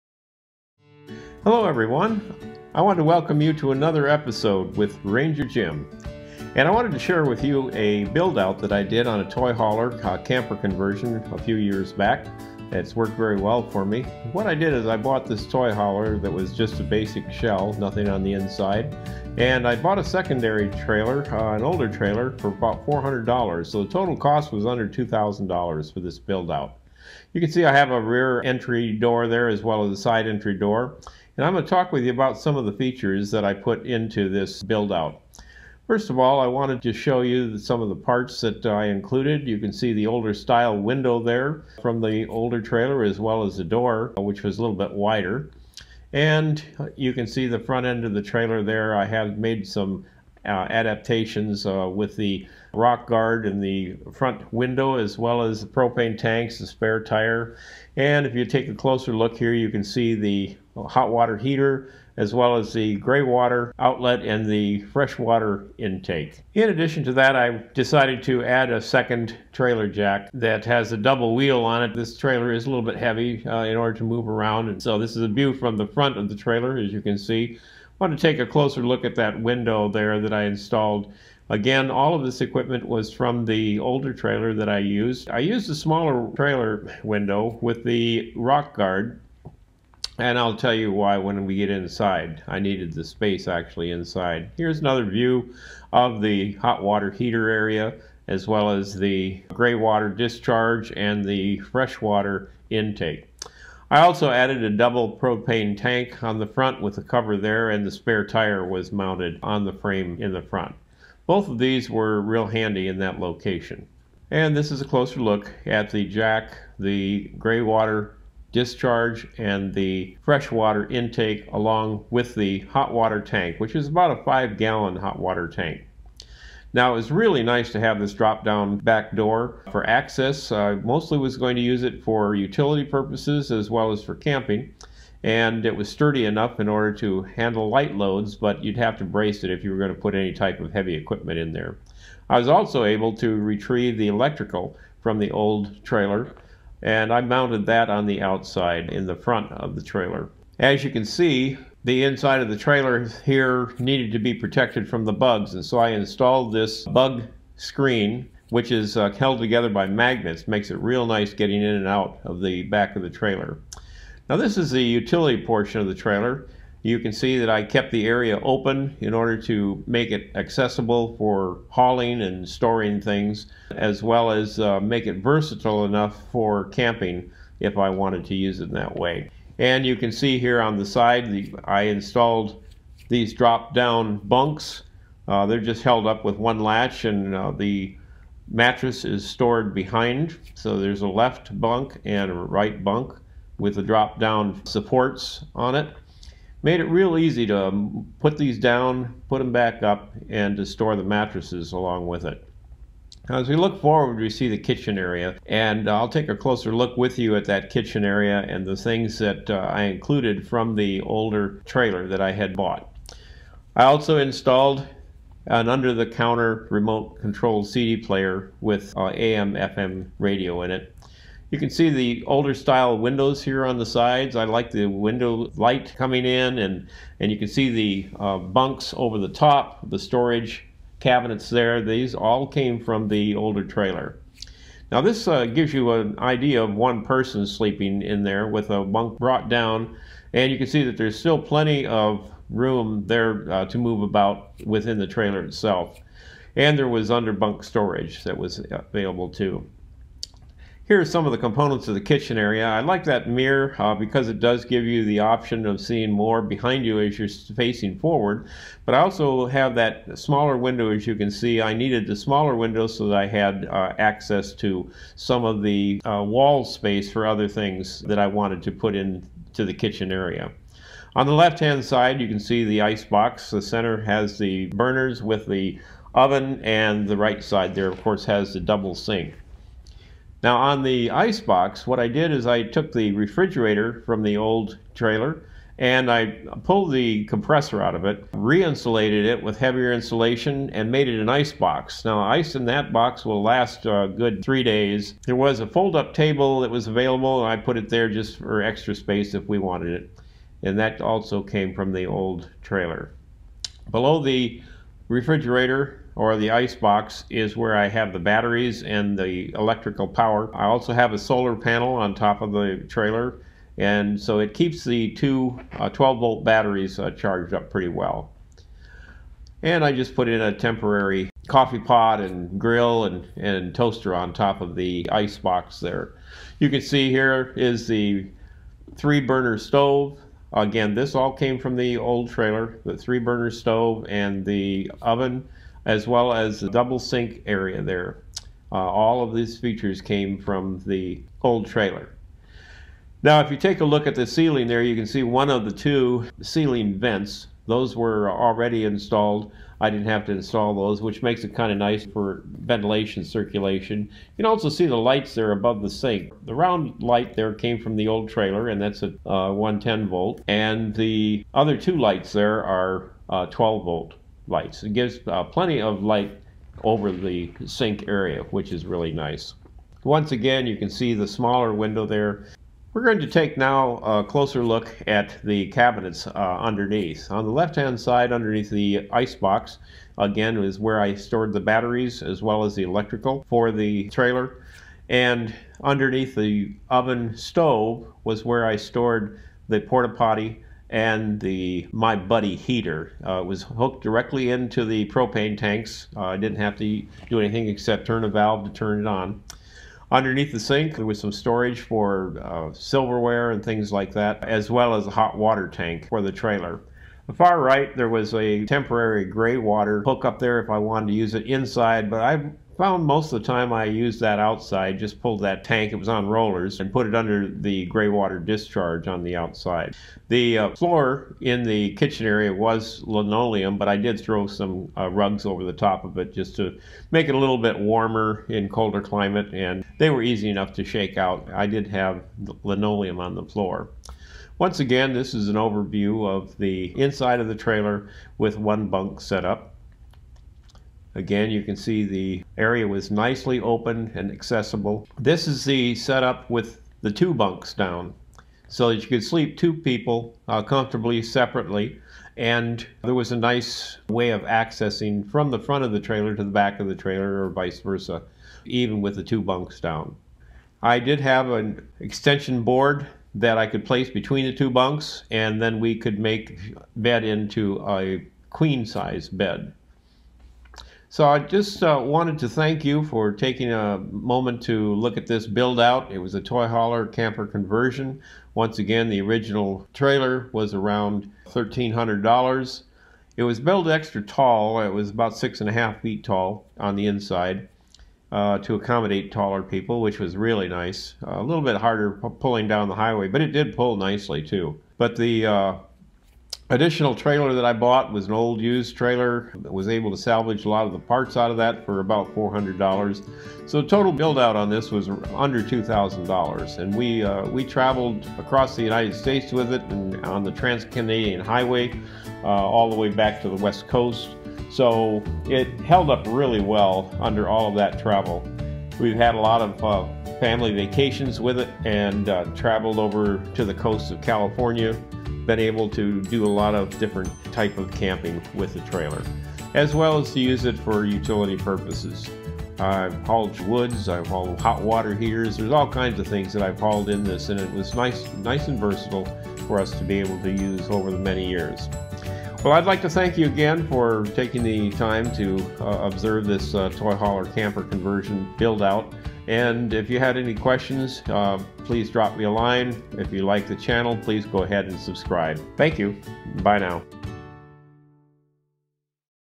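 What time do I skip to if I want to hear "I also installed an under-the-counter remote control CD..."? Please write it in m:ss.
3:33.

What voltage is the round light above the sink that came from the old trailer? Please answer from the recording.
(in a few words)
110 volt.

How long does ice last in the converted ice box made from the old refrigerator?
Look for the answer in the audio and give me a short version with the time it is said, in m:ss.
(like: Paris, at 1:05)
3 days, at 4:54.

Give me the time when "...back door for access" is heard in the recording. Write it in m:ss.
2:08.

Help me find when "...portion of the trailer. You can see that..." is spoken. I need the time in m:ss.
2:45.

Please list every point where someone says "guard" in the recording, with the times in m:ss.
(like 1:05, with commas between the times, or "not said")
0:53, 1:28.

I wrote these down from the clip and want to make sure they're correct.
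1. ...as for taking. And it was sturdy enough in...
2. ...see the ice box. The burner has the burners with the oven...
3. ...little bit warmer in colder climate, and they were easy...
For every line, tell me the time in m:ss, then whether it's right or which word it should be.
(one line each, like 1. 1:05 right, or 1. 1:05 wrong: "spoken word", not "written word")
1. 2:13 wrong: "camping", not "taking"
2. 4:32 wrong: "center", not "burner"
3. 7:07 right.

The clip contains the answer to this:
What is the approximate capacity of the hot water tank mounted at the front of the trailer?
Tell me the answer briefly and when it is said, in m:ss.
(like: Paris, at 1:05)
5 gallons, at 2:04.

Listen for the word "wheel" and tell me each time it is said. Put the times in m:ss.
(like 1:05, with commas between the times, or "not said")
1:11.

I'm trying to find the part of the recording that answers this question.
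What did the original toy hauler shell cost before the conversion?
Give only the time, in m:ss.
8:01.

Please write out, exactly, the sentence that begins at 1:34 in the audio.
Here's another view of the hot water heater area as well as the gray water discharge and the fresh water intake.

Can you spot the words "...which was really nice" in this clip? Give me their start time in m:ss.
8:09.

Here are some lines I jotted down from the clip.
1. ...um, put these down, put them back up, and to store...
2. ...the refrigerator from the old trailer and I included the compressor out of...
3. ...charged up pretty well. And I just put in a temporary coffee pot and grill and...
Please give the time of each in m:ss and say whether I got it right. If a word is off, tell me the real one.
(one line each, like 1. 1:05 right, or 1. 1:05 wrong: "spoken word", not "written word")
1. 3:17 right
2. 4:42 wrong: "pulled", not "included"
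3. 5:17 right.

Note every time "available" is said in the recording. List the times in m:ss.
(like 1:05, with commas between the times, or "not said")
4:08, 4:56.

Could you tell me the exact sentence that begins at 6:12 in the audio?
We're going to take now a closer look at the cabinets uh, underneath.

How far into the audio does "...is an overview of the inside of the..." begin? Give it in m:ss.
7:15.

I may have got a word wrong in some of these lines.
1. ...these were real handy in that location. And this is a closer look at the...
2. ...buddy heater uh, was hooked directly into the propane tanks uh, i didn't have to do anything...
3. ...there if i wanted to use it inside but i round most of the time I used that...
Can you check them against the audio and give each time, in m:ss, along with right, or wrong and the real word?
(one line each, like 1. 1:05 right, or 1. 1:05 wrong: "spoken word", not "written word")
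1. 1:51 right
2. 6:32 right
3. 6:50 wrong: "found", not "round".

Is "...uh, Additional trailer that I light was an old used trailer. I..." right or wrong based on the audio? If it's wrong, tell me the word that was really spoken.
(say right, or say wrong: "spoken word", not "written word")
wrong: "bought", not "light".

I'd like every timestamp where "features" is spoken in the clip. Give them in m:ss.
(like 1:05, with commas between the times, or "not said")
0:32, 5:39.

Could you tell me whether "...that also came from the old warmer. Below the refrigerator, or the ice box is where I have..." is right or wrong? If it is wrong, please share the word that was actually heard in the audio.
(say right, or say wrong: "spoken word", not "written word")
wrong: "trailer", not "warmer".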